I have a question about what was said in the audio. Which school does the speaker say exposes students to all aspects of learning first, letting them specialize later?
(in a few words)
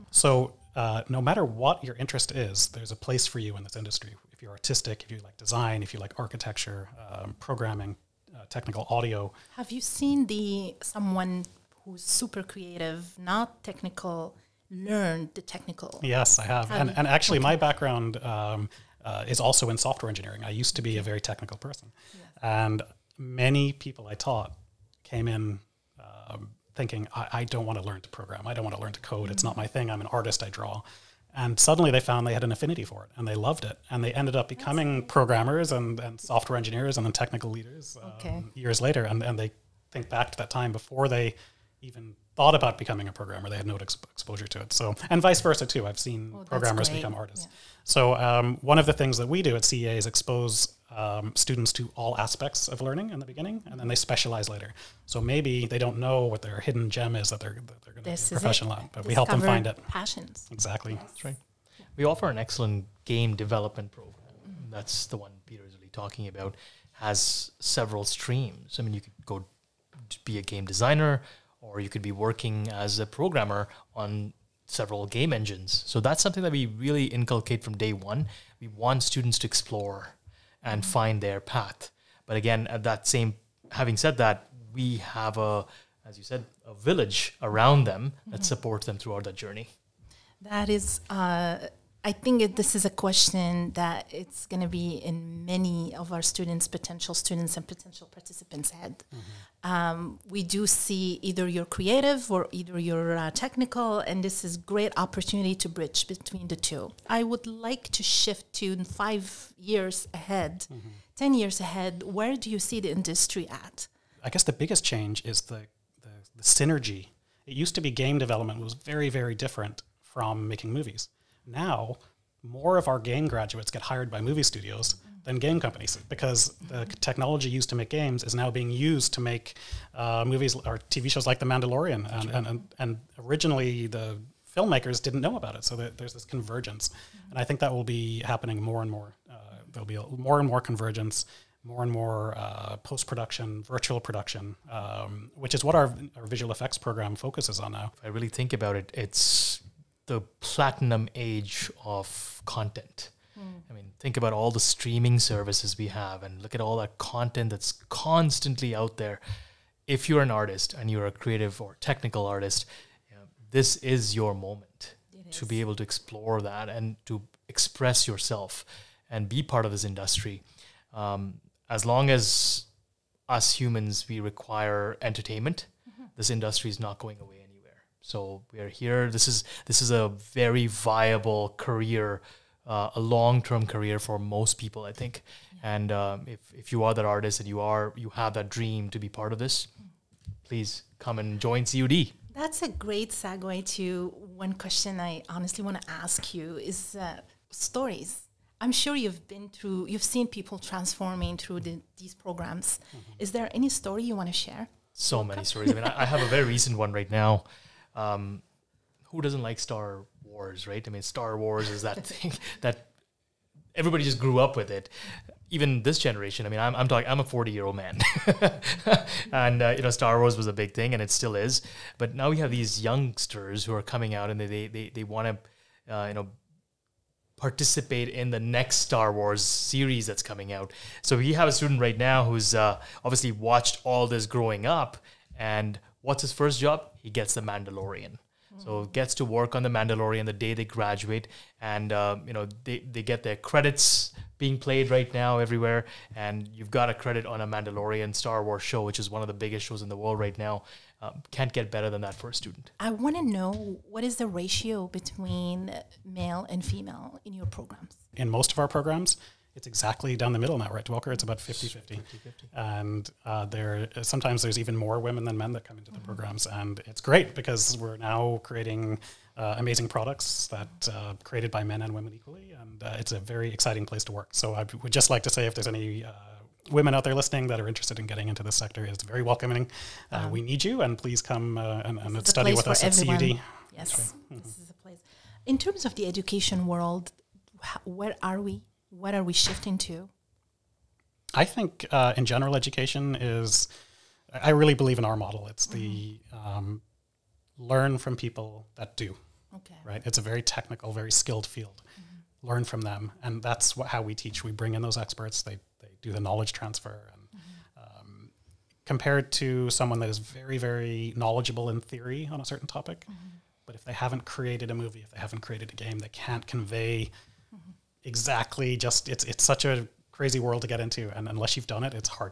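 CEA.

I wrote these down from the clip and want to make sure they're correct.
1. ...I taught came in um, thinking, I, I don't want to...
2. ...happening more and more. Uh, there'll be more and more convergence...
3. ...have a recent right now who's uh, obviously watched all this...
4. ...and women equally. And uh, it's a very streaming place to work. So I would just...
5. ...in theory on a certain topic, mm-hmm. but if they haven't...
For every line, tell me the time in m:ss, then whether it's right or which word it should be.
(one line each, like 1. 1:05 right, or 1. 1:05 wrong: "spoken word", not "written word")
1. 0:24 right
2. 2:18 right
3. 3:51 wrong: "student", not "recent"
4. 4:31 wrong: "exciting", not "streaming"
5. 5:11 right.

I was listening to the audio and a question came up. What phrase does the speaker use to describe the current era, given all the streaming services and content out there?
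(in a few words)
platinum age of content.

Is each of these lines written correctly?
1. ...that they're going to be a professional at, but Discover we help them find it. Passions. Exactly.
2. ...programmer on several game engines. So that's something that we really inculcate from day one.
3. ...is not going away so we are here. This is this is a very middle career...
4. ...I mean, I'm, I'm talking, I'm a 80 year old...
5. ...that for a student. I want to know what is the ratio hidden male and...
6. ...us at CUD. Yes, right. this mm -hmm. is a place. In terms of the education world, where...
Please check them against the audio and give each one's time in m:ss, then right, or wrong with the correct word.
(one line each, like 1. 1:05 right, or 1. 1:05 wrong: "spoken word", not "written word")
1. 0:57 right
2. 1:13 right
3. 2:56 wrong: "viable", not "middle"
4. 3:36 wrong: "40", not "80"
5. 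4:12 wrong: "between", not "hidden"
6. 4:42 right.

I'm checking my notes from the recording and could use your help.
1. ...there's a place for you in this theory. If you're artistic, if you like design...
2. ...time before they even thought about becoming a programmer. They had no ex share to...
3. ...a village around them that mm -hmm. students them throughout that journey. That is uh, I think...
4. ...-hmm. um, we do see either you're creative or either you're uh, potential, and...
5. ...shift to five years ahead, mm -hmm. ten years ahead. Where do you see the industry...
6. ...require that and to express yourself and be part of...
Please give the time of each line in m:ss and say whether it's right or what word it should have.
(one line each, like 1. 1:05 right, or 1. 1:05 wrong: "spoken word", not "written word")
1. 0:02 wrong: "industry", not "theory"
2. 0:40 wrong: "exposure", not "share"
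3. 1:26 wrong: "supports", not "students"
4. 1:39 wrong: "technical", not "potential"
5. 1:48 right
6. 2:45 wrong: "explore", not "require".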